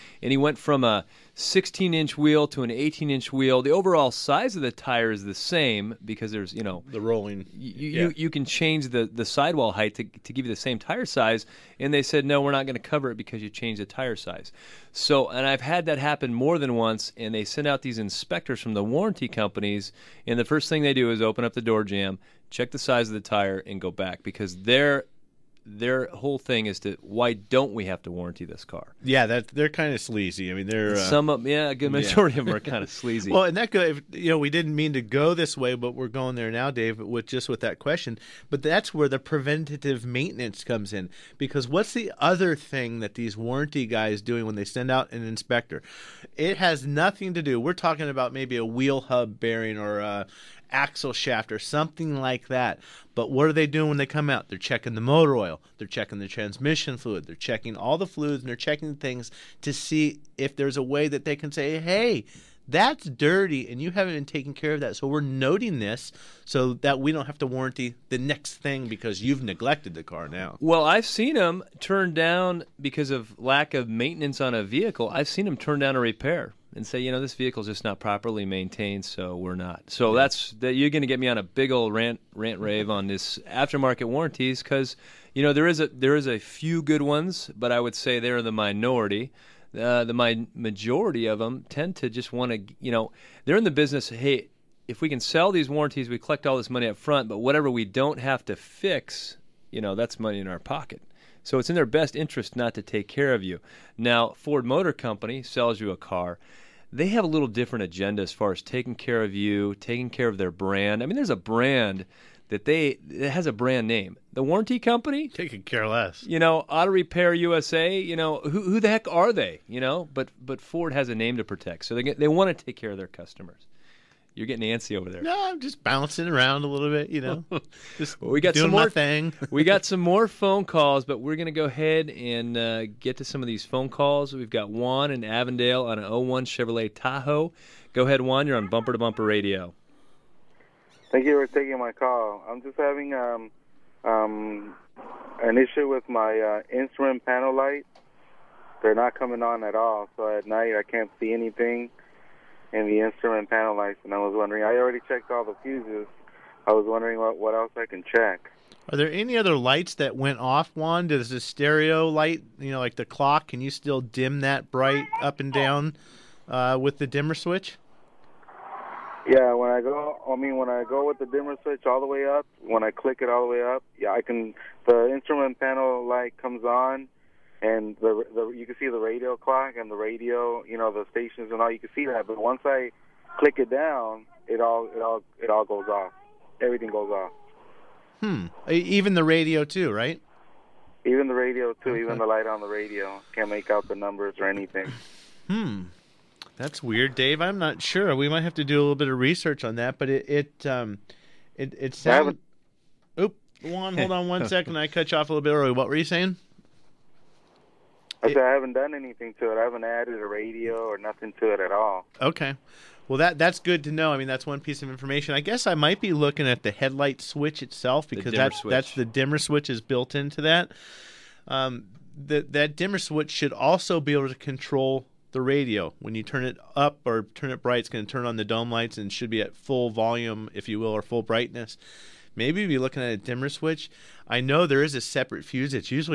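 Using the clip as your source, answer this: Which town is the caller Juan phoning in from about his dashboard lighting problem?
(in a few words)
Avondale.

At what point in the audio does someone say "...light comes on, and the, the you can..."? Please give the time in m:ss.
2:56.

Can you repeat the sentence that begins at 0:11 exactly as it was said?
And they said, no, we're not going to cover it because you changed the tire size.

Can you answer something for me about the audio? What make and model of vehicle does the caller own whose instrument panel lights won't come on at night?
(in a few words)
Chevrolet Tahoe.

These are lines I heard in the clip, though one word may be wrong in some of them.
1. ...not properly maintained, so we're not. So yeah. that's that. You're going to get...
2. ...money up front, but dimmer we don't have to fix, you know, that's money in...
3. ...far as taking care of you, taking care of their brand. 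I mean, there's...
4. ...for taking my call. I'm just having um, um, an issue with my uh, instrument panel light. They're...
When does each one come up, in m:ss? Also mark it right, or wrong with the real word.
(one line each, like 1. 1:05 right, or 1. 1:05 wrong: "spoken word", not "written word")
1. 1:17 right
2. 1:36 wrong: "whatever", not "dimmer"
3. 1:48 right
4. 2:21 right.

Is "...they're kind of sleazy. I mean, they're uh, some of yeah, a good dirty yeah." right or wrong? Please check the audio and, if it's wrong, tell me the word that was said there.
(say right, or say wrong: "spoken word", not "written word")
wrong: "majority", not "dirty".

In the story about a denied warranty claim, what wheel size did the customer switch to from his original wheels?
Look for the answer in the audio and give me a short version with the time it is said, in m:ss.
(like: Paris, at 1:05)
18 inch, at 0:02.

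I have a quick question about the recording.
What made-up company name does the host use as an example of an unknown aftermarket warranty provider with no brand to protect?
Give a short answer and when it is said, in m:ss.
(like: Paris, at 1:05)
Auto Repair USA, at 1:56.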